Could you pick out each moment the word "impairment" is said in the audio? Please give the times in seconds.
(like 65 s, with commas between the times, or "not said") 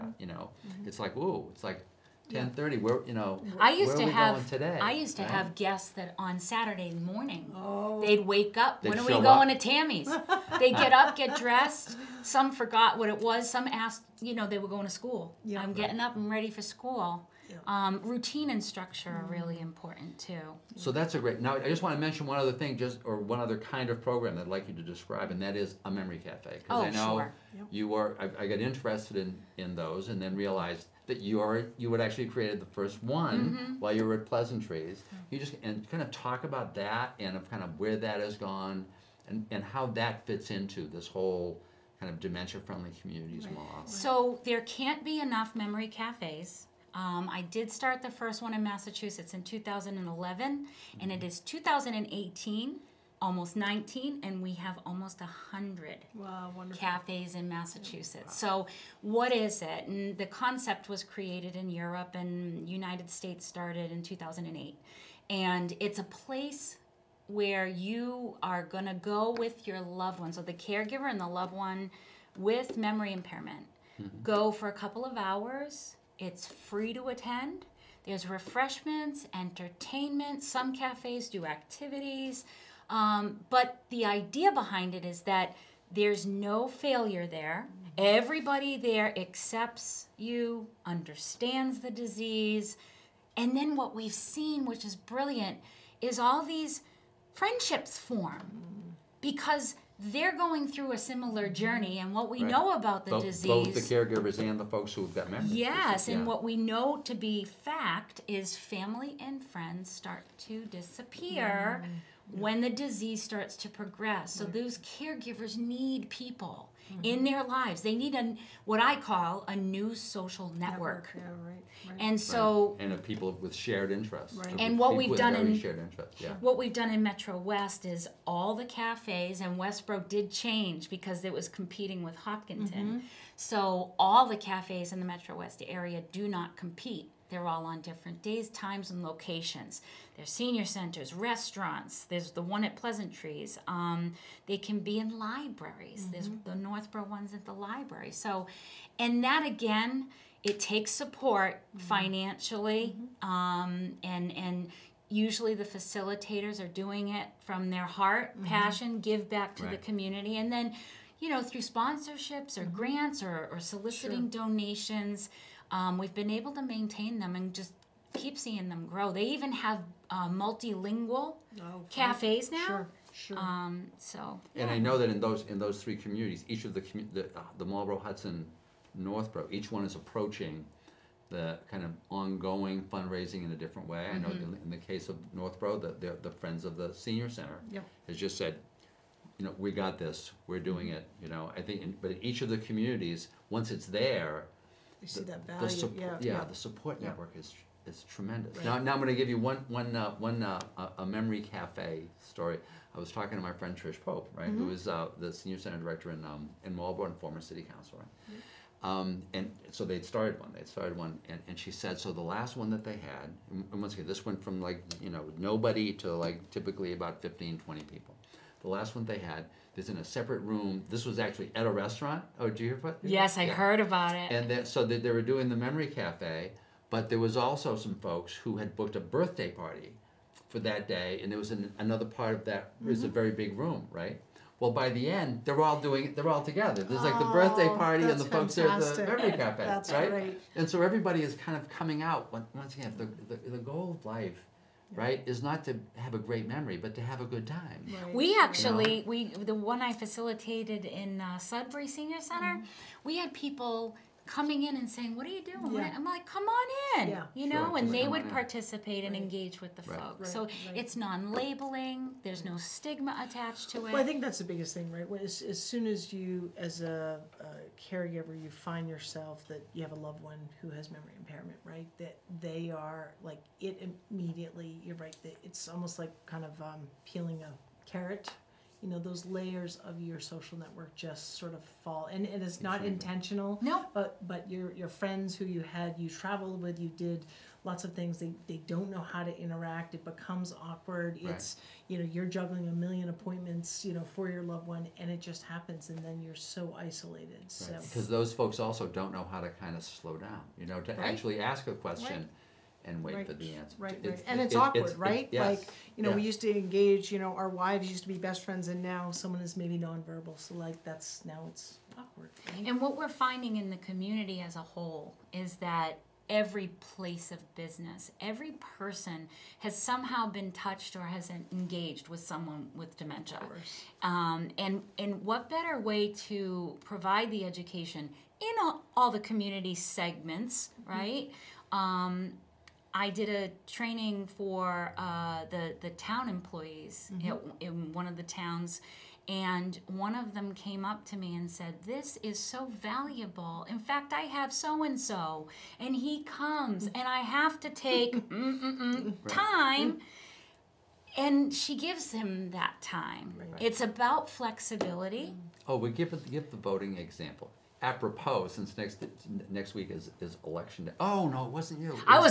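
73 s, 271 s.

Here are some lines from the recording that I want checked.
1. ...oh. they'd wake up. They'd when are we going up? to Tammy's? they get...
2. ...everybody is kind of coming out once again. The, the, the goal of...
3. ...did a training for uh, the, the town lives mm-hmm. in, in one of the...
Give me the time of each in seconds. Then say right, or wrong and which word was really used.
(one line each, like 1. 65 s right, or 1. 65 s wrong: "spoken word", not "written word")
1. 7 s right
2. 240 s right
3. 333 s wrong: "employees", not "lives".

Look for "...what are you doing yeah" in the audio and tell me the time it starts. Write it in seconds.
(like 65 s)
255 s.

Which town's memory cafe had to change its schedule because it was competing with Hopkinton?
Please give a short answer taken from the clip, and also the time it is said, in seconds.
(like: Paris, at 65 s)
Westborough, at 129 s.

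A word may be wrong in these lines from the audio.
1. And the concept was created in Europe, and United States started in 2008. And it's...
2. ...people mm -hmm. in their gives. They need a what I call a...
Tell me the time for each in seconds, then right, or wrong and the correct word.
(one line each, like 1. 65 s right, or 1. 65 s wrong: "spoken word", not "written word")
1. 59 s right
2. 116 s wrong: "lives", not "gives".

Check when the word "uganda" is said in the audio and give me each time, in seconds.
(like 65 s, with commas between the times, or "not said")
not said.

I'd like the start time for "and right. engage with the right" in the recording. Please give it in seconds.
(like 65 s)
259 s.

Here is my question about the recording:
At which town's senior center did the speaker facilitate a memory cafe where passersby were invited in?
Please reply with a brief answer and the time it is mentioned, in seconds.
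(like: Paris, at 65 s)
Sudbury, at 251 s.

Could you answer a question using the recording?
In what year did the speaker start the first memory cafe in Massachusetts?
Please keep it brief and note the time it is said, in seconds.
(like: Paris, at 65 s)
2011, at 49 s.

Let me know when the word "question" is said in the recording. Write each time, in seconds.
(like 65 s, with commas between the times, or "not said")
301 s.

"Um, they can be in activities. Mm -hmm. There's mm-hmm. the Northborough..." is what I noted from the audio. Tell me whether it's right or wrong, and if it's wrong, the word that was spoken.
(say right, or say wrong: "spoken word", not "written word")
wrong: "libraries", not "activities".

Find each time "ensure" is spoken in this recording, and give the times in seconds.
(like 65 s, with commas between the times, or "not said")
not said.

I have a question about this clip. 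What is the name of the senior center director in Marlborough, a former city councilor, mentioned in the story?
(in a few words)
Trish Pope.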